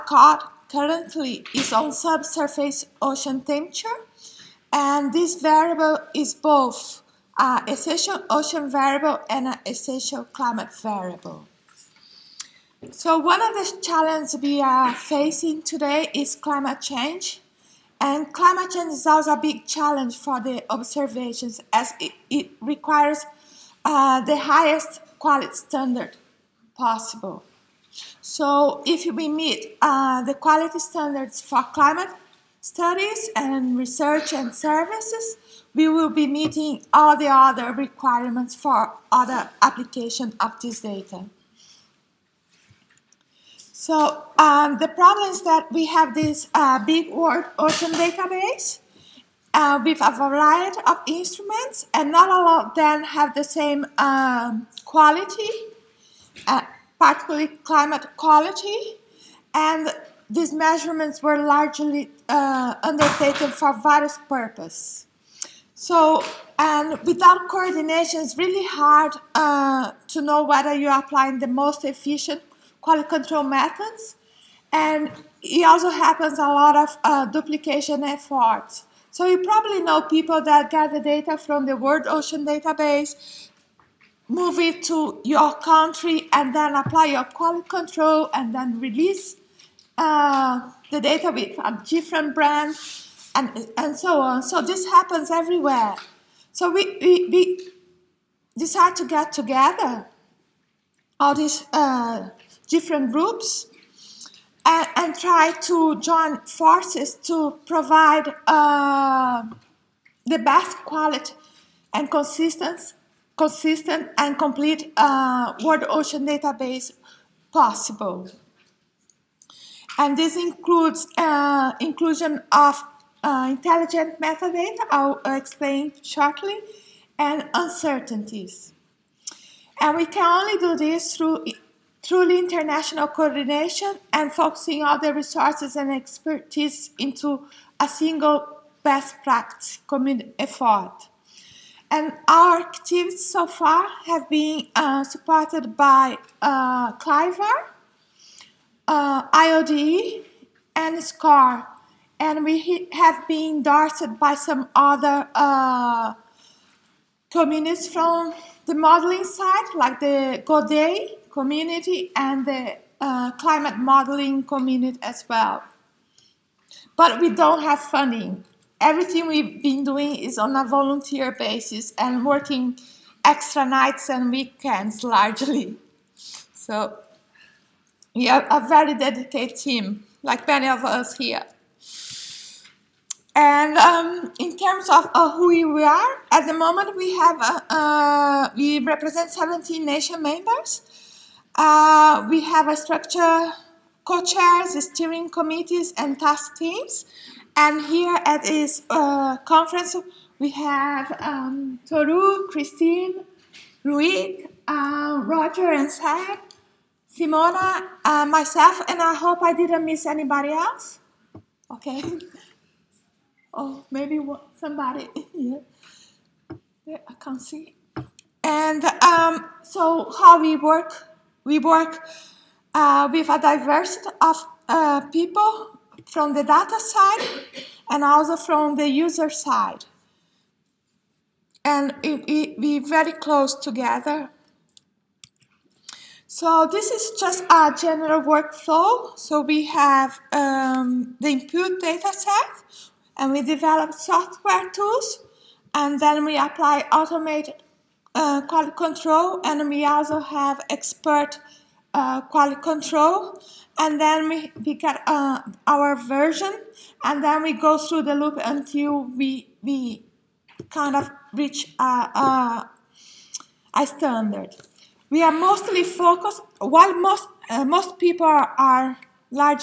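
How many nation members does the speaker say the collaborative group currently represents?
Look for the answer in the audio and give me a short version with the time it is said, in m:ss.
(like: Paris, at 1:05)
17, at 3:09.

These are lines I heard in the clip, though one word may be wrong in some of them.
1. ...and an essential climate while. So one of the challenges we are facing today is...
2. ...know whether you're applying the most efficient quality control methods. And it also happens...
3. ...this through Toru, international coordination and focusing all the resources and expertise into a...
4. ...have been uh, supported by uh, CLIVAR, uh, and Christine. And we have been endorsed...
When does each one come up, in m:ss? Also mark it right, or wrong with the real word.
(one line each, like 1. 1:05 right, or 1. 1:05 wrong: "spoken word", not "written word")
1. 0:09 wrong: "variable", not "while"
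2. 1:10 right
3. 2:10 wrong: "Truly", not "Toru"
4. 2:24 wrong: "SCAR", not "Christine".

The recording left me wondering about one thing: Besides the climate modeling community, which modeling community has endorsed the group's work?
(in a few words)
GODAE.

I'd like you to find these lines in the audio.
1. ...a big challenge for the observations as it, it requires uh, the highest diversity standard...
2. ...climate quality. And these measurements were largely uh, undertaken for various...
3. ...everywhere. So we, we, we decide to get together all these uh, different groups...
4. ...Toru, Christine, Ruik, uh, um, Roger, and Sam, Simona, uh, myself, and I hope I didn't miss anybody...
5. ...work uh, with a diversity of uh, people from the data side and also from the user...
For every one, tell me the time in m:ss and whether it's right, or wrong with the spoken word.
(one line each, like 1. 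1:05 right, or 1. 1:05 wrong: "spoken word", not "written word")
1. 0:19 wrong: "quality", not "diversity"
2. 0:57 right
3. 1:35 right
4. 3:21 right
5. 3:41 right.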